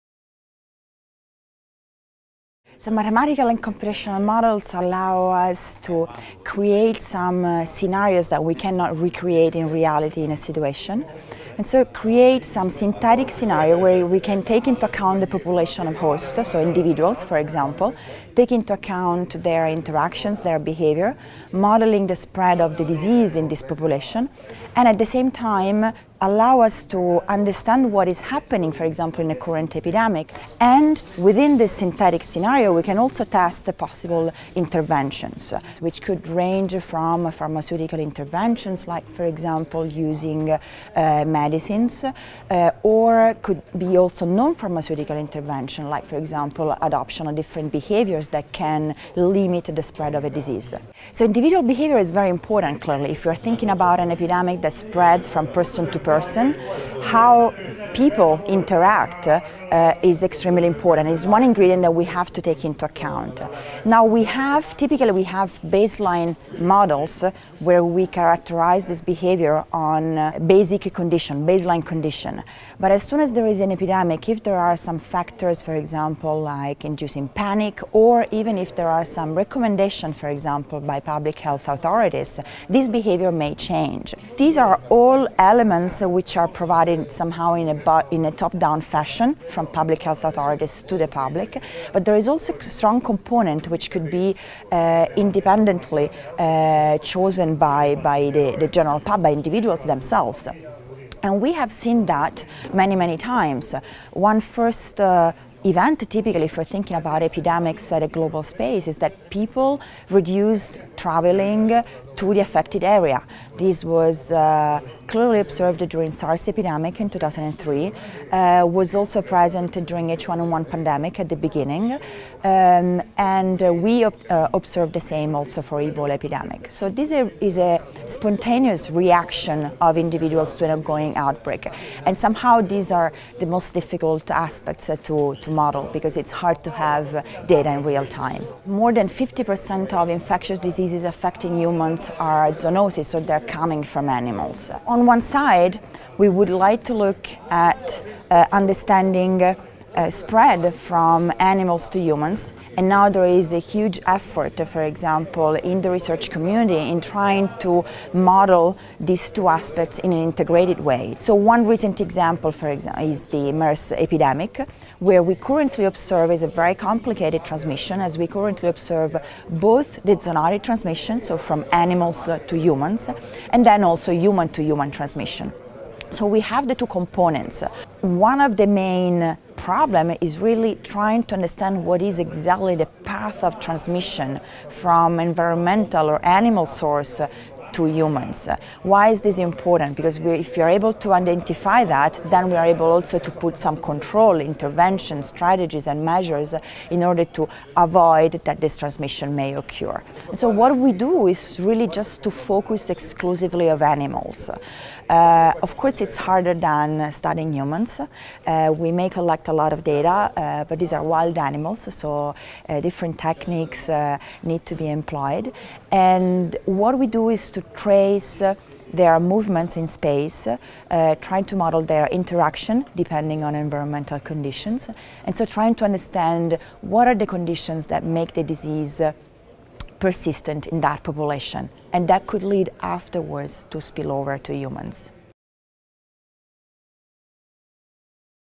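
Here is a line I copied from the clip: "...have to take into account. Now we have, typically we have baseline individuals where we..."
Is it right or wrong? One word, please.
wrong.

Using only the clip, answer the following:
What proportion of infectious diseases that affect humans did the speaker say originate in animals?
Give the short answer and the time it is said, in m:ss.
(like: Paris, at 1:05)
More than 50%, at 2:18.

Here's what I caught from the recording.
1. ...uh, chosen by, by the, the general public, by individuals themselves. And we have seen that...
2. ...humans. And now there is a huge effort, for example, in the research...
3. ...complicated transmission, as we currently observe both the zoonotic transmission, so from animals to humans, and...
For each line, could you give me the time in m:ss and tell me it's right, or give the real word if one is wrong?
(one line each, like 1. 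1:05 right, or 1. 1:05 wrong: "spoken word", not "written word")
1. 1:36 right
2. 2:31 right
3. 2:46 right.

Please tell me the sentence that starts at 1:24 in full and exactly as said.
These are all elements which are provided somehow in a, in a top-down fashion from public health authorities to the public.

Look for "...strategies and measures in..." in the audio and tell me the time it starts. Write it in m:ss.
3:15.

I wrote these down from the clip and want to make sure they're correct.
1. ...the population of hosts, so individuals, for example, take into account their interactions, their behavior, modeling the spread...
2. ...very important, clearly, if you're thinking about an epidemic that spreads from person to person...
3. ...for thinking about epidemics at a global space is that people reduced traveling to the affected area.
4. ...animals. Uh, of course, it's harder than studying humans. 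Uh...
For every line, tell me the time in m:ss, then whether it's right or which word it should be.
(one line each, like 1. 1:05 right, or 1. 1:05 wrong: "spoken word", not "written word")
1. 0:15 right
2. 0:52 right
3. 1:46 right
4. 3:23 right.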